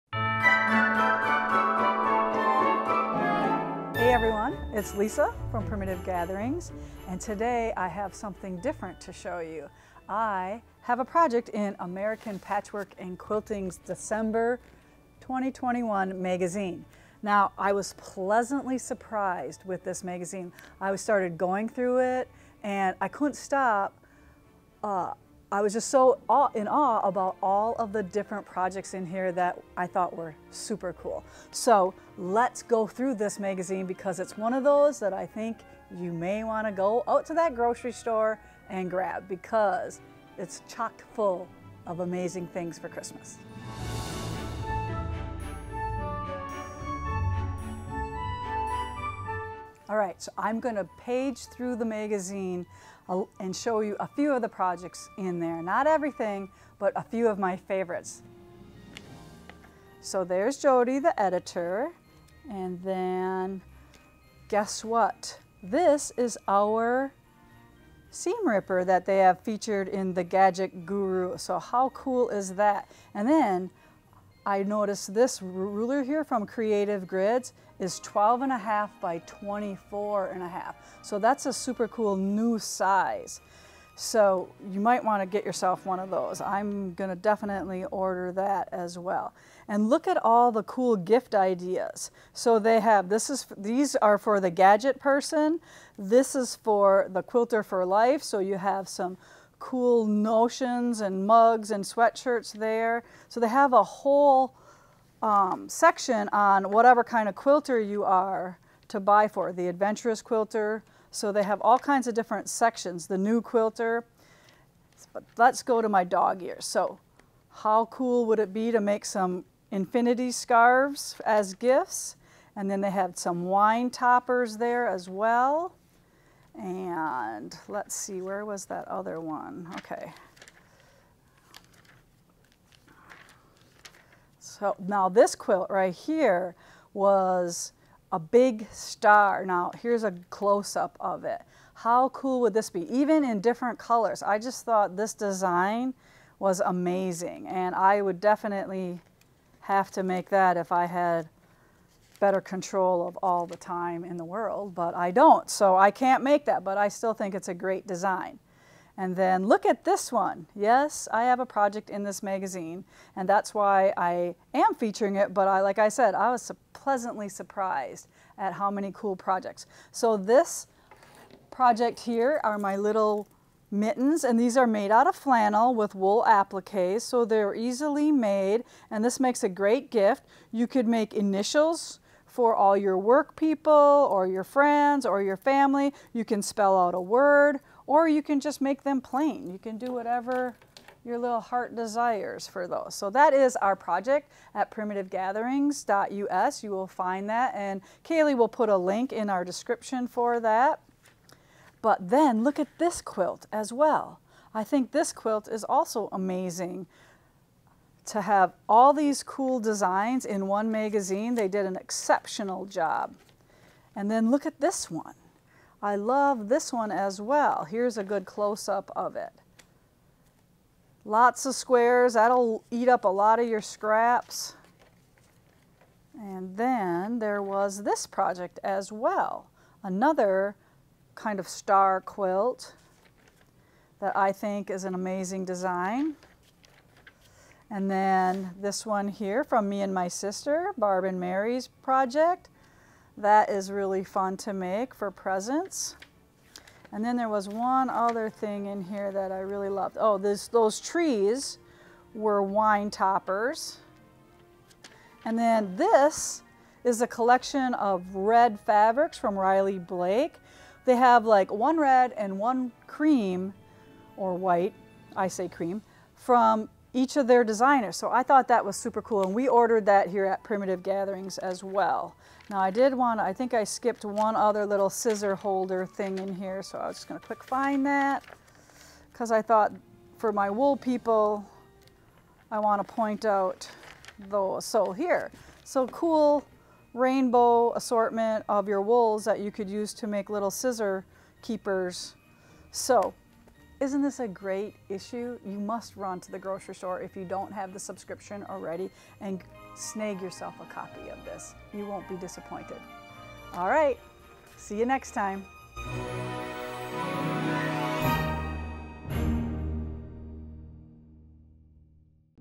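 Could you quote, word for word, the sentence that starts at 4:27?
So I thought that was super cool.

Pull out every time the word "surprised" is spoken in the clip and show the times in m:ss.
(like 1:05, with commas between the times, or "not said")
0:18, 2:47.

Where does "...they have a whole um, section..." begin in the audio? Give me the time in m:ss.
1:43.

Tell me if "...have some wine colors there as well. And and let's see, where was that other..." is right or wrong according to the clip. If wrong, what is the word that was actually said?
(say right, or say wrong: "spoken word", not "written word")
wrong: "toppers", not "colors".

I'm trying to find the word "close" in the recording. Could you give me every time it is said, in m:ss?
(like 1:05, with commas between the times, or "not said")
2:20, 3:38.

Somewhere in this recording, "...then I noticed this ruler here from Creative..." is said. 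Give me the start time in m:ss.
1:13.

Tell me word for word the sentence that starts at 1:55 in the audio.
But let's go to my dog ears.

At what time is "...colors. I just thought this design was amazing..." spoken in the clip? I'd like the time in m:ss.
2:23.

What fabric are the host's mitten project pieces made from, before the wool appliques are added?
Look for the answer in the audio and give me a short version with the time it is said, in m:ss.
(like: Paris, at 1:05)
flannel, at 2:55.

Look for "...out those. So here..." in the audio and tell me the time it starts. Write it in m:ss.
4:43.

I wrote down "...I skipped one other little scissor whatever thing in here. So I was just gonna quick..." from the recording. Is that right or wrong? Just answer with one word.
wrong.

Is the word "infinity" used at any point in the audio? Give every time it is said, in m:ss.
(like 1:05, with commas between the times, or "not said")
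1:59.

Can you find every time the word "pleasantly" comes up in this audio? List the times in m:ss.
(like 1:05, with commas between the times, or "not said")
0:17, 2:46.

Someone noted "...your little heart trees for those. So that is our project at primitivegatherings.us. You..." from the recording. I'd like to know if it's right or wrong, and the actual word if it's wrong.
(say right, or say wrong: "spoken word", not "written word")
wrong: "desires", not "trees".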